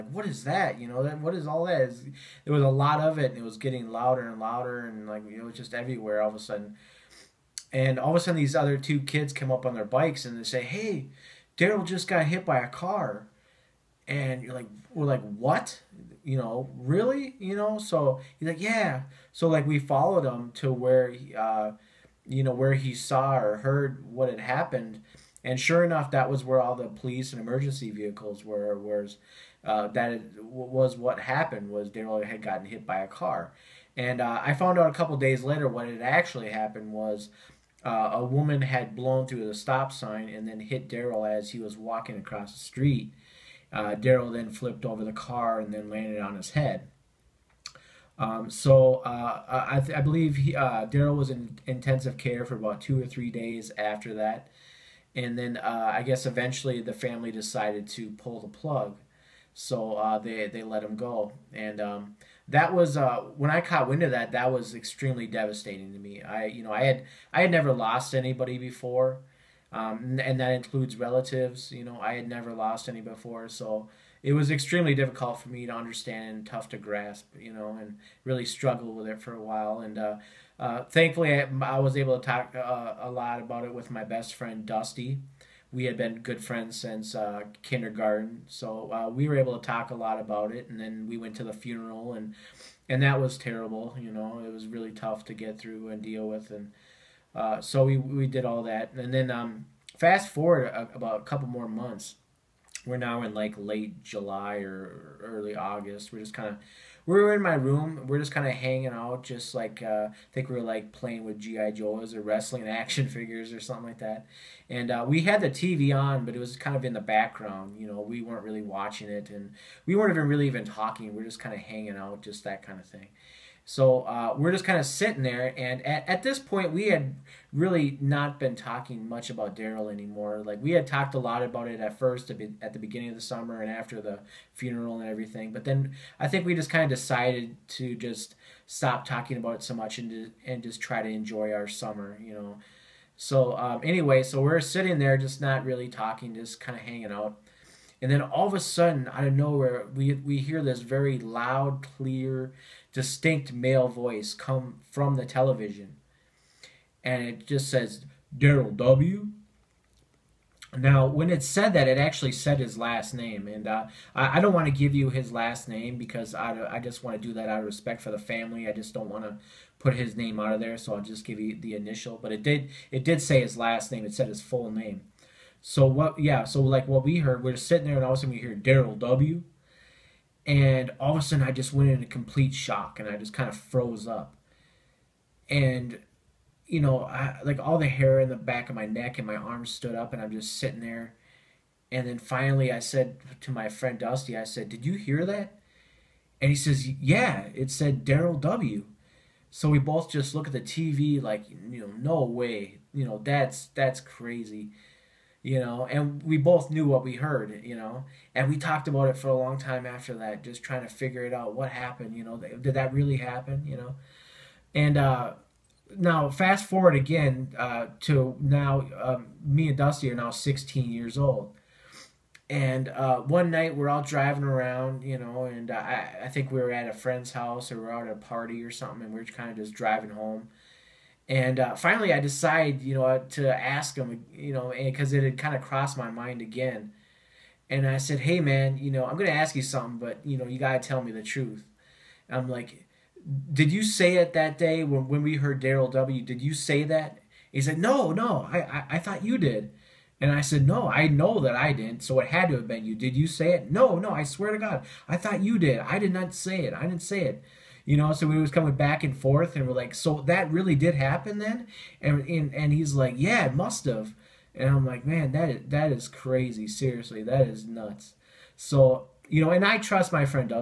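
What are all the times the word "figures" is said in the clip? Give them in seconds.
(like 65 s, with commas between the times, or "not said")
113 s, 210 s.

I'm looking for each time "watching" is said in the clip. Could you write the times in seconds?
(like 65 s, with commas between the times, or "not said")
118 s.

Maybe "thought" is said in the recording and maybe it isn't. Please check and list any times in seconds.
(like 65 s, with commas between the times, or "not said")
248 s, 255 s.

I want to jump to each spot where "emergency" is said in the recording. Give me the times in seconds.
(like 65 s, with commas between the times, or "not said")
27 s.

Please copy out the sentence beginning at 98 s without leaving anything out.
And then um, fast forward a, about a couple more months, we're now in like late July or early August.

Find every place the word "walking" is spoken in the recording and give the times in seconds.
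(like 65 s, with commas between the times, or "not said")
41 s.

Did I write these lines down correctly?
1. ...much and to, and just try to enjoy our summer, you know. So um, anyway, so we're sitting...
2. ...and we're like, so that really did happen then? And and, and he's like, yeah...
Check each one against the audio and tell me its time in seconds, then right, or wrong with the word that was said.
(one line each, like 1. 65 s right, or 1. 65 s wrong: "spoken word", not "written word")
1. 139 s right
2. 259 s right.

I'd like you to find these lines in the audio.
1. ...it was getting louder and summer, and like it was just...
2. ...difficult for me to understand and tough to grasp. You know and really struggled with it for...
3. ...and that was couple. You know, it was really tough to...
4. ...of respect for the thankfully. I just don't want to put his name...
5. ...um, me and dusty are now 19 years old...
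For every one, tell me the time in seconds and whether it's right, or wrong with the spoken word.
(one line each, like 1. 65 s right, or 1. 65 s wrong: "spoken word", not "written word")
1. 3 s wrong: "louder", not "summer"
2. 74 s right
3. 92 s wrong: "terrible", not "couple"
4. 167 s wrong: "family", not "thankfully"
5. 218 s wrong: "16", not "19".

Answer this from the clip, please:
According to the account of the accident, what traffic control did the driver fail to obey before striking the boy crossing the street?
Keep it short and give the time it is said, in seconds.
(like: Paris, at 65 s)
stop sign, at 39 s.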